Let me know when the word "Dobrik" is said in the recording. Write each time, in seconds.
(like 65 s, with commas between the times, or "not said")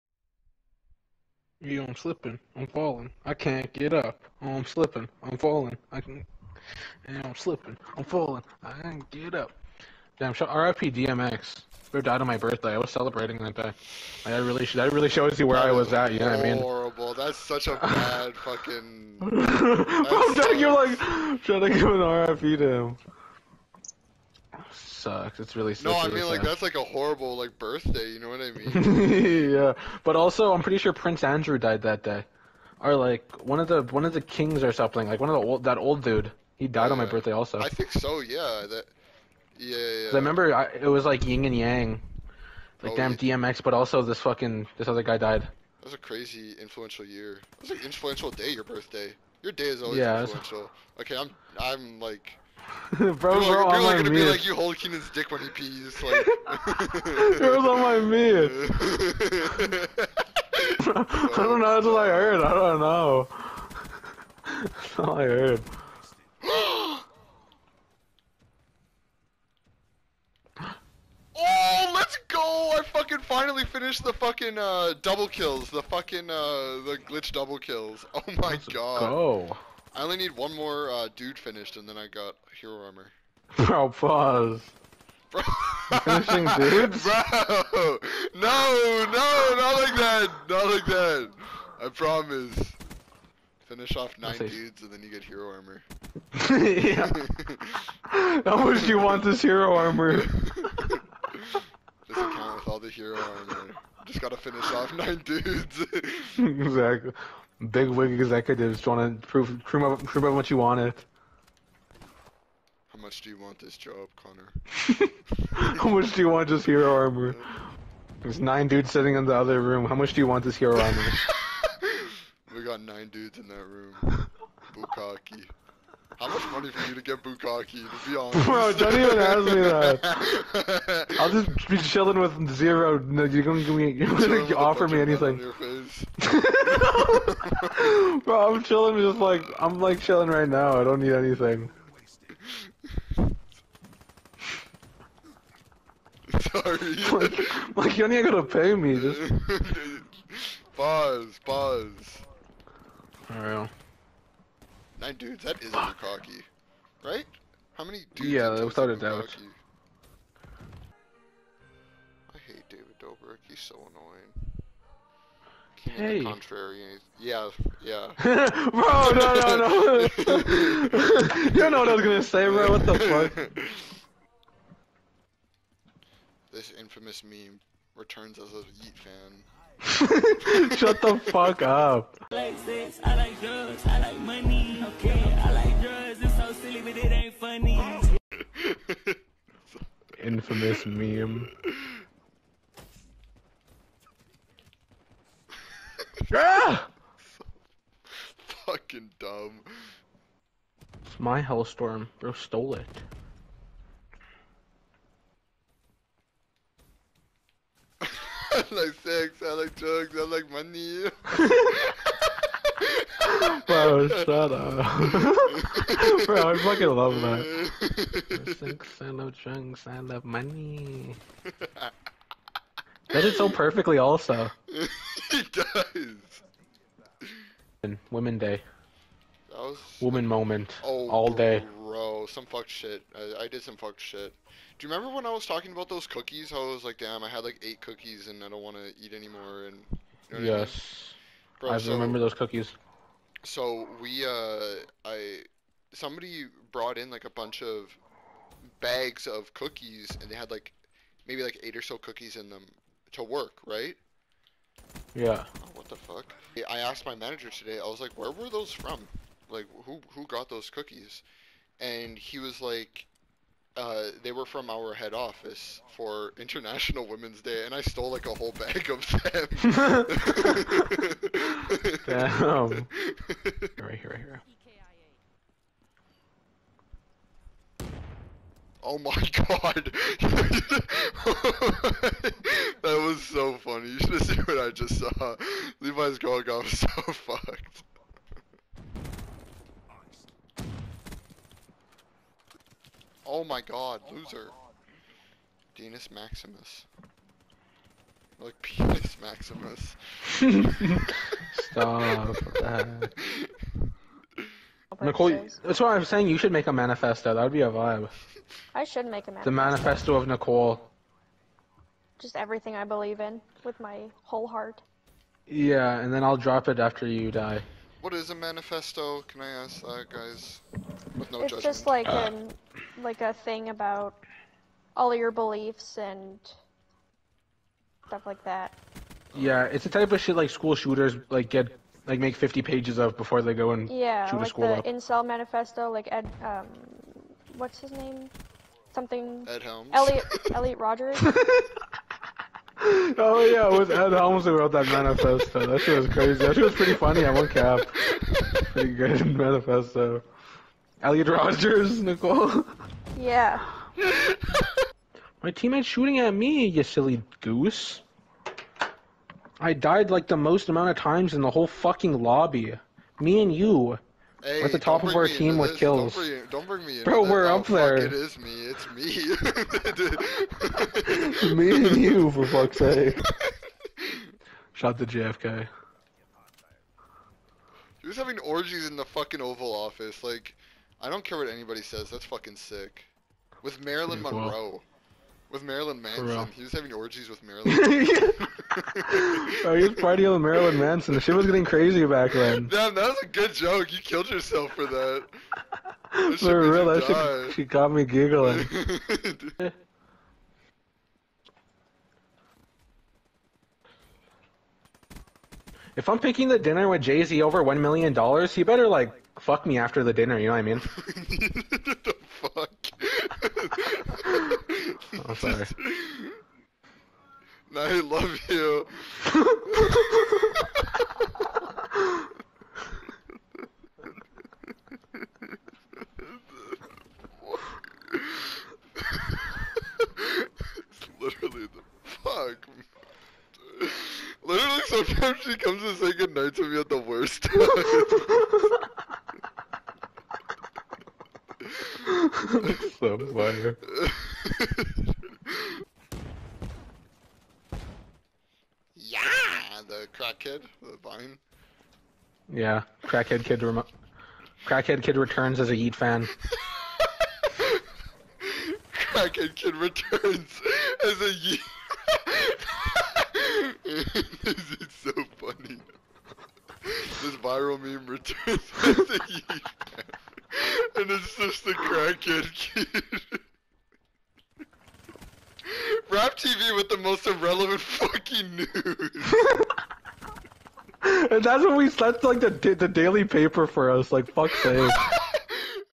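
162 s.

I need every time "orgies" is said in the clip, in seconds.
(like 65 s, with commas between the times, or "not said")
378 s, 386 s.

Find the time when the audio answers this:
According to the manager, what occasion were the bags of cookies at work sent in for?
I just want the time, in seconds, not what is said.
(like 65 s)
266 s.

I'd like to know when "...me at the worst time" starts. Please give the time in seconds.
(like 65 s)
436 s.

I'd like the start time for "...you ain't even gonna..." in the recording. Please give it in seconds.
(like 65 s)
147 s.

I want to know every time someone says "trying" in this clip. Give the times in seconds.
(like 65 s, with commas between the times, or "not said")
21 s, 108 s.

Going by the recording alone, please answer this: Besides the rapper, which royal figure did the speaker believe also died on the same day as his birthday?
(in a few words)
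Prince Andrew.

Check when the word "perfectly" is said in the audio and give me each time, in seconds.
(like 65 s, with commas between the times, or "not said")
223 s.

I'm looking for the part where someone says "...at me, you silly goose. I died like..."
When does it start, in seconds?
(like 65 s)
356 s.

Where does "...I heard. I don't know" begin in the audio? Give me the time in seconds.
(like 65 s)
61 s.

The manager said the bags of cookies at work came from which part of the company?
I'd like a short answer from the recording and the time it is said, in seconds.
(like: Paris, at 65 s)
head office, at 264 s.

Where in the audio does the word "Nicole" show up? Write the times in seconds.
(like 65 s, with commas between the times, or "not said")
305 s, 310 s, 352 s.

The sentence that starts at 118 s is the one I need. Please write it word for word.
There's nine dudes sitting in the other room.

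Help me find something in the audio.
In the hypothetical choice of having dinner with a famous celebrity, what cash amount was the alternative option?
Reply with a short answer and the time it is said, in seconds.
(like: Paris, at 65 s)
1 million dollars, at 407 s.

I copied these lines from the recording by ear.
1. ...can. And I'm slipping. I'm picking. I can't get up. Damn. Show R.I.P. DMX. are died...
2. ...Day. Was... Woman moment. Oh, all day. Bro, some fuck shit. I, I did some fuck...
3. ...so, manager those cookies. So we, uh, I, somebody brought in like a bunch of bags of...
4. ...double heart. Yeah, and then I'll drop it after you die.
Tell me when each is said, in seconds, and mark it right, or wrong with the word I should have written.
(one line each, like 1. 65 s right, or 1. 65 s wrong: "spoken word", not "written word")
1. 6 s wrong: "falling", not "picking"
2. 228 s right
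3. 241 s wrong: "remember", not "manager"
4. 314 s wrong: "whole", not "double".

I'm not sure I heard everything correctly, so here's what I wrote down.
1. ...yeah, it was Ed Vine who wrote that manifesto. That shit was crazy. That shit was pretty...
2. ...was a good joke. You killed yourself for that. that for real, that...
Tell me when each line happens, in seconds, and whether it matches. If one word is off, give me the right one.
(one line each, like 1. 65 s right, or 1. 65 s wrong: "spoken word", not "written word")
1. 343 s wrong: "Helms", not "Vine"
2. 393 s right.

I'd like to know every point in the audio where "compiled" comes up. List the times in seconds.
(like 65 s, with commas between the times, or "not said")
not said.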